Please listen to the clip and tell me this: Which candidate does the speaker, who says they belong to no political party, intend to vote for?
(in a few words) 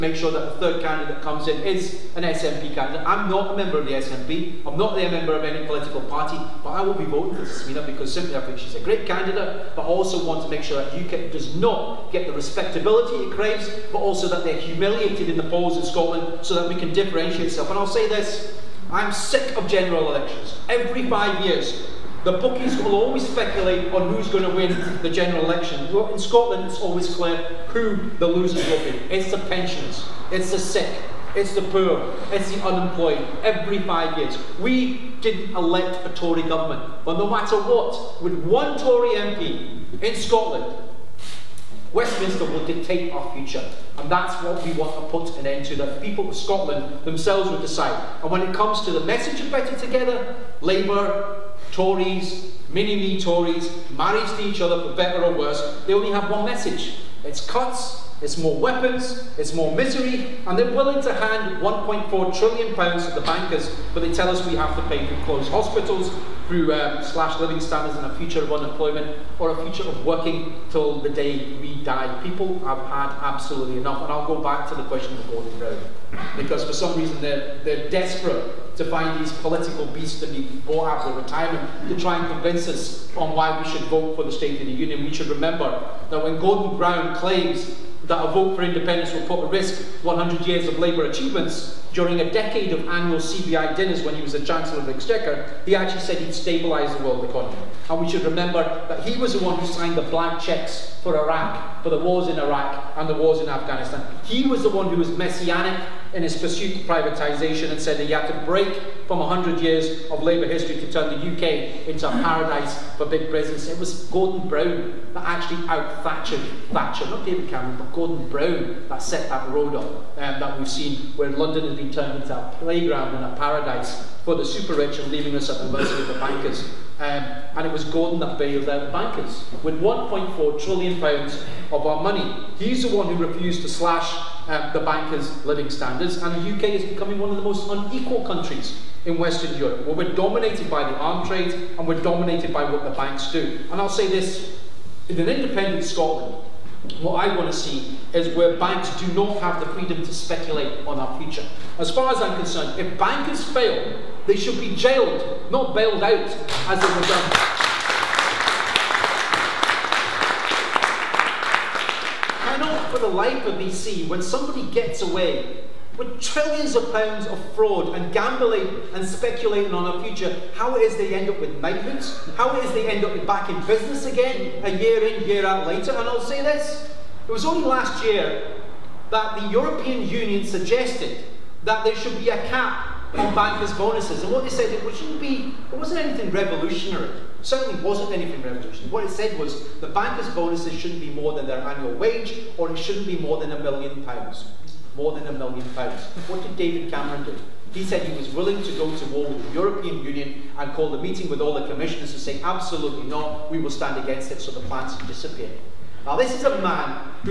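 Smina.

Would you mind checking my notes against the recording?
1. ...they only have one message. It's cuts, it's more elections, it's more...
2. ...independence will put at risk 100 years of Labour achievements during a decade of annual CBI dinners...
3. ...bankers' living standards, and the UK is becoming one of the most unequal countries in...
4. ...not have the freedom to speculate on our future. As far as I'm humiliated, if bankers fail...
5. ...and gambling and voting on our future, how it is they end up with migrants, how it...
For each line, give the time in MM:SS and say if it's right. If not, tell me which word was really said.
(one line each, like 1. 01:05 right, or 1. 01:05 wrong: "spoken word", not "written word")
1. 00:55 wrong: "weapons", not "elections"
2. 01:28 right
3. 02:14 right
4. 02:29 wrong: "concerned", not "humiliated"
5. 02:47 wrong: "speculating", not "voting".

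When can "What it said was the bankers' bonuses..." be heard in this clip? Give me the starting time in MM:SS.
03:08.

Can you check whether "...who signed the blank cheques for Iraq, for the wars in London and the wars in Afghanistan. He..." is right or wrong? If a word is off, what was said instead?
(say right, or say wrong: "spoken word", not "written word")
wrong: "Iraq", not "London".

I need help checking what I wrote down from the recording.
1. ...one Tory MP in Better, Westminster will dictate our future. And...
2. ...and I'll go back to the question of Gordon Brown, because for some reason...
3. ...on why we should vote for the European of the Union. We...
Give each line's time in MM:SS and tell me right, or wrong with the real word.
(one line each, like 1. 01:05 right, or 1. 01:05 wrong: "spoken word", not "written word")
1. 00:38 wrong: "Scotland", not "Better"
2. 01:14 right
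3. 01:23 wrong: "State", not "European".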